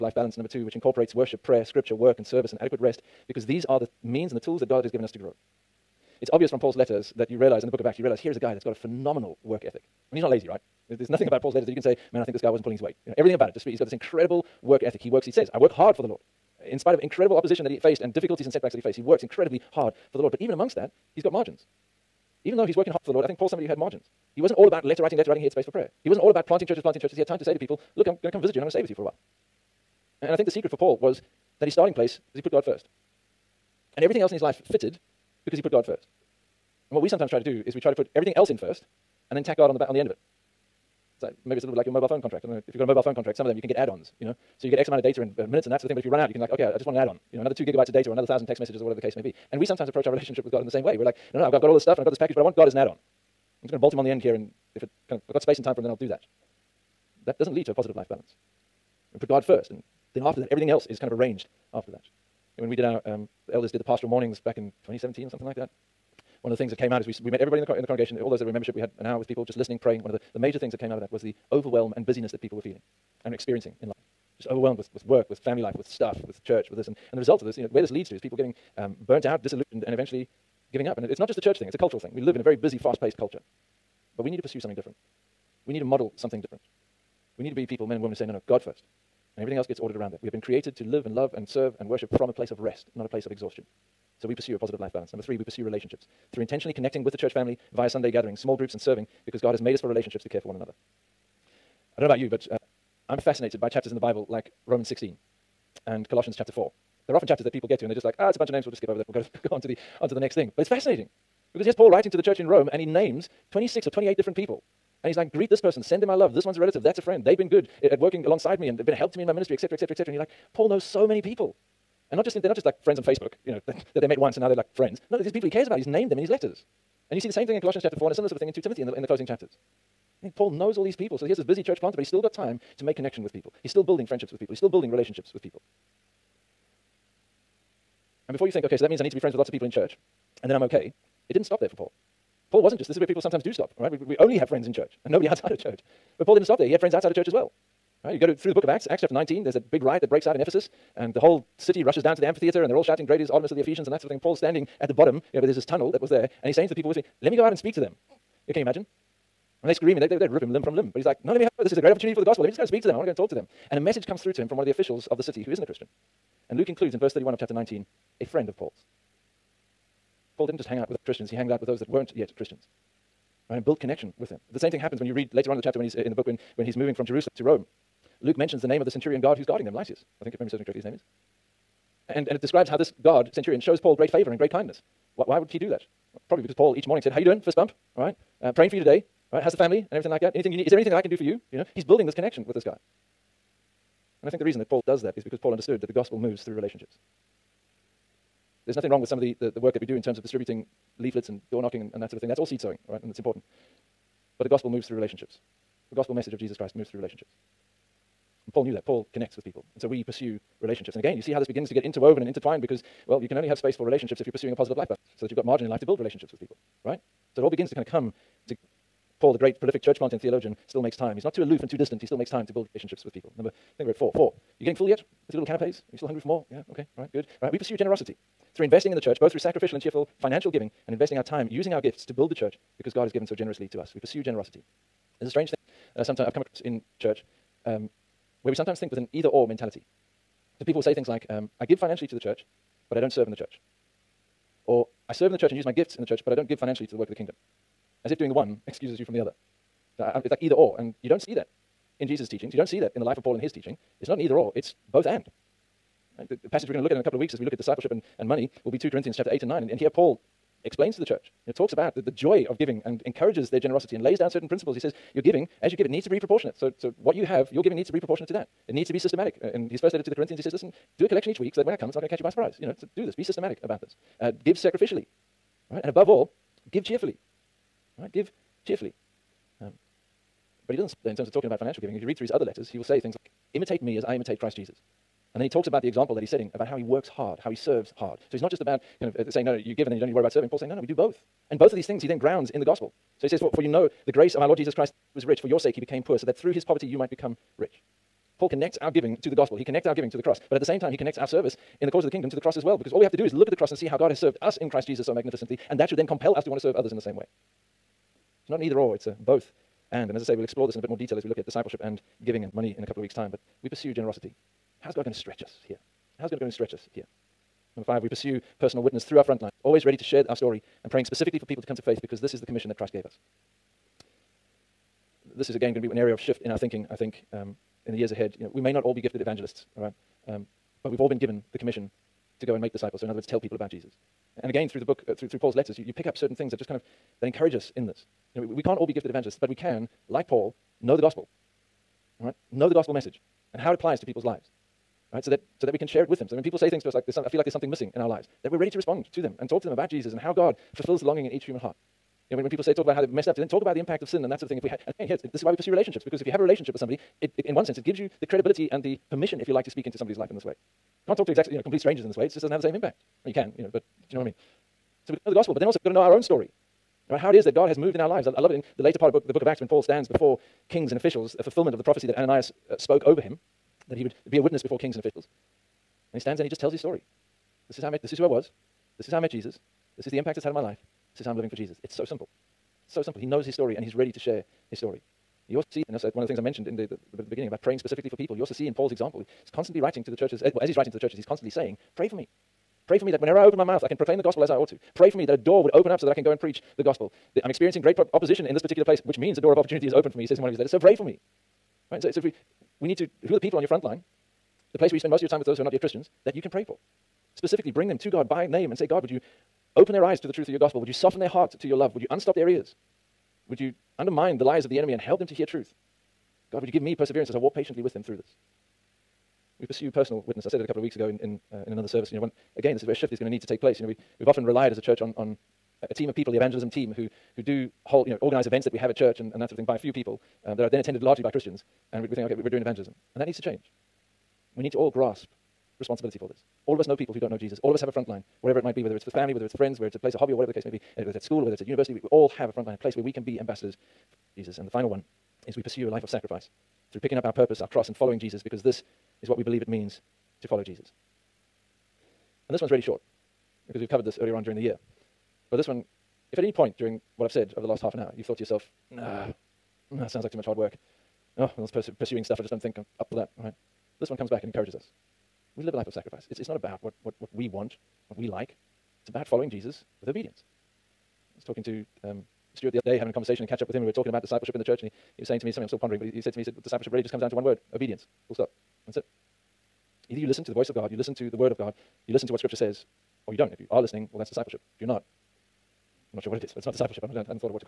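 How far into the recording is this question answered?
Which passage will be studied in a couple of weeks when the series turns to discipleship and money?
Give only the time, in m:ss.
4:18.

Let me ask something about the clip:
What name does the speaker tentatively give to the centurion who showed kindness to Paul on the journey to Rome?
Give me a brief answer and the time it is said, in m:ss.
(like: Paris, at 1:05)
Lysias, at 2:59.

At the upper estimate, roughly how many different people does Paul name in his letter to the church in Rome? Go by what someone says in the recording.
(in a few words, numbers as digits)
28.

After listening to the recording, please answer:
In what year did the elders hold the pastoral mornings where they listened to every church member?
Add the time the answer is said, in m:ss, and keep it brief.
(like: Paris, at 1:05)
2017, at 1:04.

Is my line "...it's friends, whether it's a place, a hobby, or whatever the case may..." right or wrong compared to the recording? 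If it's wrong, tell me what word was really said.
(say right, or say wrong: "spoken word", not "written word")
right.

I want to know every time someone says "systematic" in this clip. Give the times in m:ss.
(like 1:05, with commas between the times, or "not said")
4:28, 4:33.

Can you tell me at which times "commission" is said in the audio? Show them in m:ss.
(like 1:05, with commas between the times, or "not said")
5:22, 5:31.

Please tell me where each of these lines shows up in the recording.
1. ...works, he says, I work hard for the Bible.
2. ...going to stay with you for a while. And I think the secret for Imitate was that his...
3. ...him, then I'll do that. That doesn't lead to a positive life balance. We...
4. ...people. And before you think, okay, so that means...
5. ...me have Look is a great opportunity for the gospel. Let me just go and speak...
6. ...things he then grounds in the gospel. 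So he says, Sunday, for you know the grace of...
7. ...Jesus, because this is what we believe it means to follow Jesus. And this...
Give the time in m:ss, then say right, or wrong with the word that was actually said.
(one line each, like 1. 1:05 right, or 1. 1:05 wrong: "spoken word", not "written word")
1. 0:15 wrong: "Lord", not "Bible"
2. 0:28 wrong: "Paul", not "Imitate"
3. 0:55 right
4. 2:15 right
5. 2:41 wrong: "This", not "Look"
6. 4:51 wrong: "For", not "Sunday"
7. 7:28 right.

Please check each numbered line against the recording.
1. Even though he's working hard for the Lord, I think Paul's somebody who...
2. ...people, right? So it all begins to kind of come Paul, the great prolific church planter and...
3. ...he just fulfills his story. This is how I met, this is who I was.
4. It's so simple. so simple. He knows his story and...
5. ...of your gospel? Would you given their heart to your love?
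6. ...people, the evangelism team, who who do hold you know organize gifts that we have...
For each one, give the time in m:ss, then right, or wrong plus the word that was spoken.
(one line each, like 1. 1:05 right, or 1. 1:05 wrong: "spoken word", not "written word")
1. 0:22 right
2. 3:36 right
3. 6:16 wrong: "tells", not "fulfills"
4. 6:21 right
5. 6:50 wrong: "soften", not "given"
6. 7:06 wrong: "events", not "gifts".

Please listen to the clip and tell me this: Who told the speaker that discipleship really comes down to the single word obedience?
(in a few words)
Stuart.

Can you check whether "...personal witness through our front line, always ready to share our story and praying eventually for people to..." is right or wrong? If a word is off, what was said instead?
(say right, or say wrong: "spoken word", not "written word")
wrong: "specifically", not "eventually".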